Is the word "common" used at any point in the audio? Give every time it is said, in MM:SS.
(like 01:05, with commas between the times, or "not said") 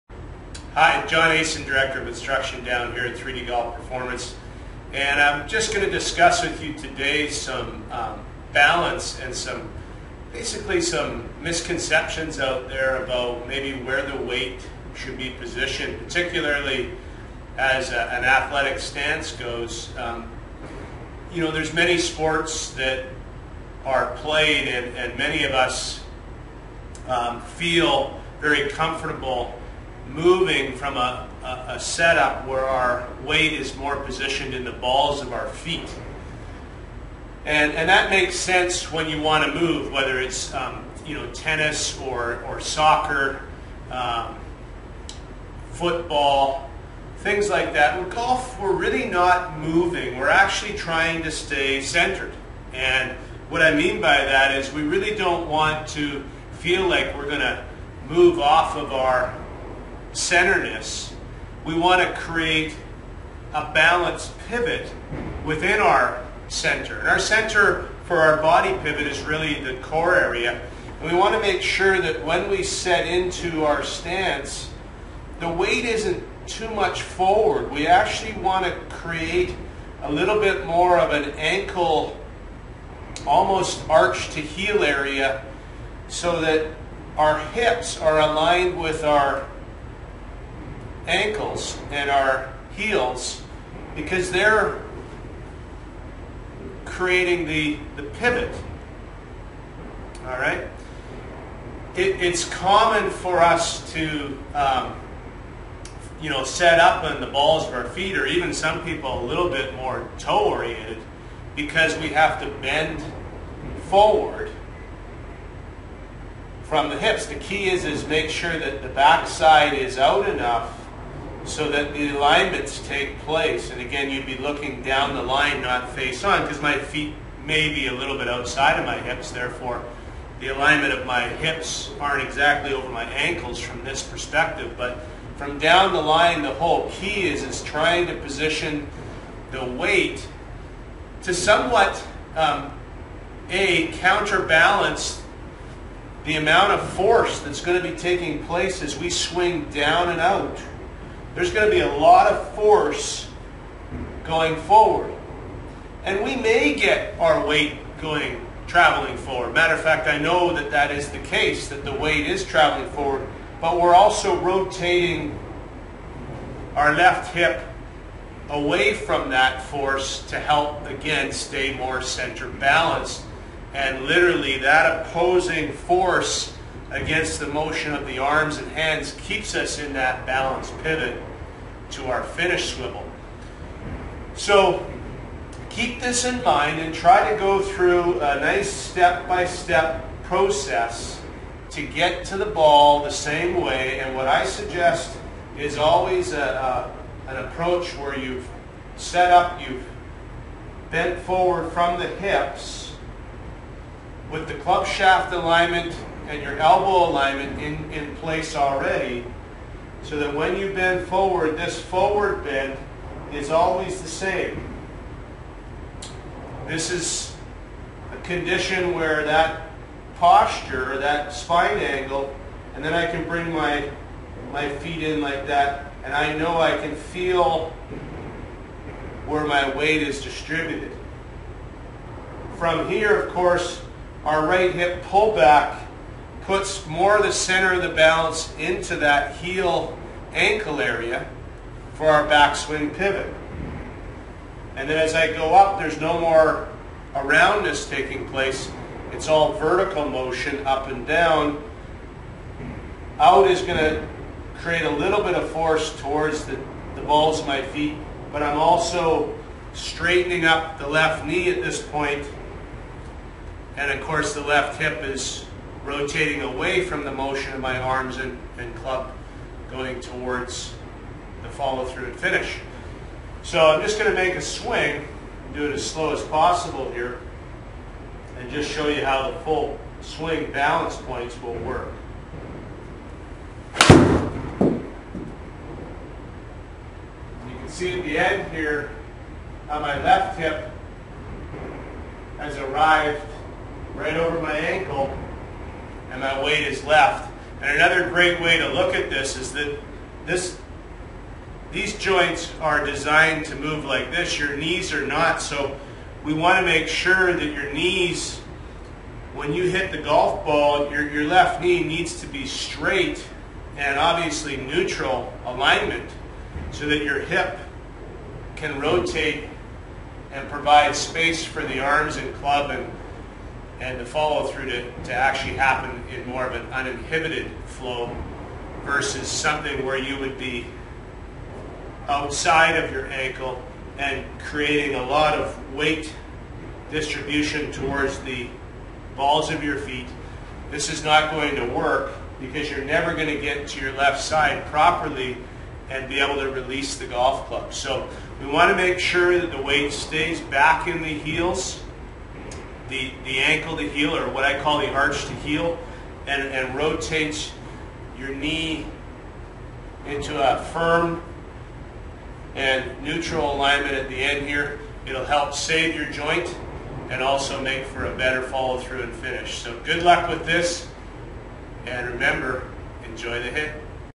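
01:42.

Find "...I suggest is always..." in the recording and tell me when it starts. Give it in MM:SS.
03:14.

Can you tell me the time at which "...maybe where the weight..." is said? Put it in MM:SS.
00:13.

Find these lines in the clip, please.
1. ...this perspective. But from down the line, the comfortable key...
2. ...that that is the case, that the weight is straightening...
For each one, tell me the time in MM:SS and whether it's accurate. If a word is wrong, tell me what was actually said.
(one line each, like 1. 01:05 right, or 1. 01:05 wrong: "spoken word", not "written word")
1. 02:13 wrong: "whole", not "comfortable"
2. 02:40 wrong: "traveling", not "straightening".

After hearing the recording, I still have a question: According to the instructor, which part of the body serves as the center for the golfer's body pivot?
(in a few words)
The core area.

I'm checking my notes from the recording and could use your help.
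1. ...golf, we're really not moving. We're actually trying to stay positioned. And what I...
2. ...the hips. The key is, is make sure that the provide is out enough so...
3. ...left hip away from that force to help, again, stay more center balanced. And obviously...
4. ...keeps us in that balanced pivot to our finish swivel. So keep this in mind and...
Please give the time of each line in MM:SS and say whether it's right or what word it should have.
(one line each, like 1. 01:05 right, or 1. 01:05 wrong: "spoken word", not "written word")
1. 00:48 wrong: "centered", not "positioned"
2. 01:56 wrong: "backside", not "provide"
3. 02:46 wrong: "literally", not "obviously"
4. 02:59 right.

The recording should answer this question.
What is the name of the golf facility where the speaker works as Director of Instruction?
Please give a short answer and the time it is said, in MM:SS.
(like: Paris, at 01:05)
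3D Golf Performance, at 00:03.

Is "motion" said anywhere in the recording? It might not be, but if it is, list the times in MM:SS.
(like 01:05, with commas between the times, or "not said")
02:57, 04:10, 04:27.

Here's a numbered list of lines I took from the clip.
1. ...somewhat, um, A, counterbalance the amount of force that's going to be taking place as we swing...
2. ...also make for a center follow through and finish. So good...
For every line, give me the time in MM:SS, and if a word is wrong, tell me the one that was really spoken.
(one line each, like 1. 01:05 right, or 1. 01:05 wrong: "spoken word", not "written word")
1. 02:21 right
2. 06:07 wrong: "better", not "center".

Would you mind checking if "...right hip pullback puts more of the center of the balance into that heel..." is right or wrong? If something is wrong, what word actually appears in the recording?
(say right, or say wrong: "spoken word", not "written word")
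right.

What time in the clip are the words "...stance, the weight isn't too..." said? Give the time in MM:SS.
01:13.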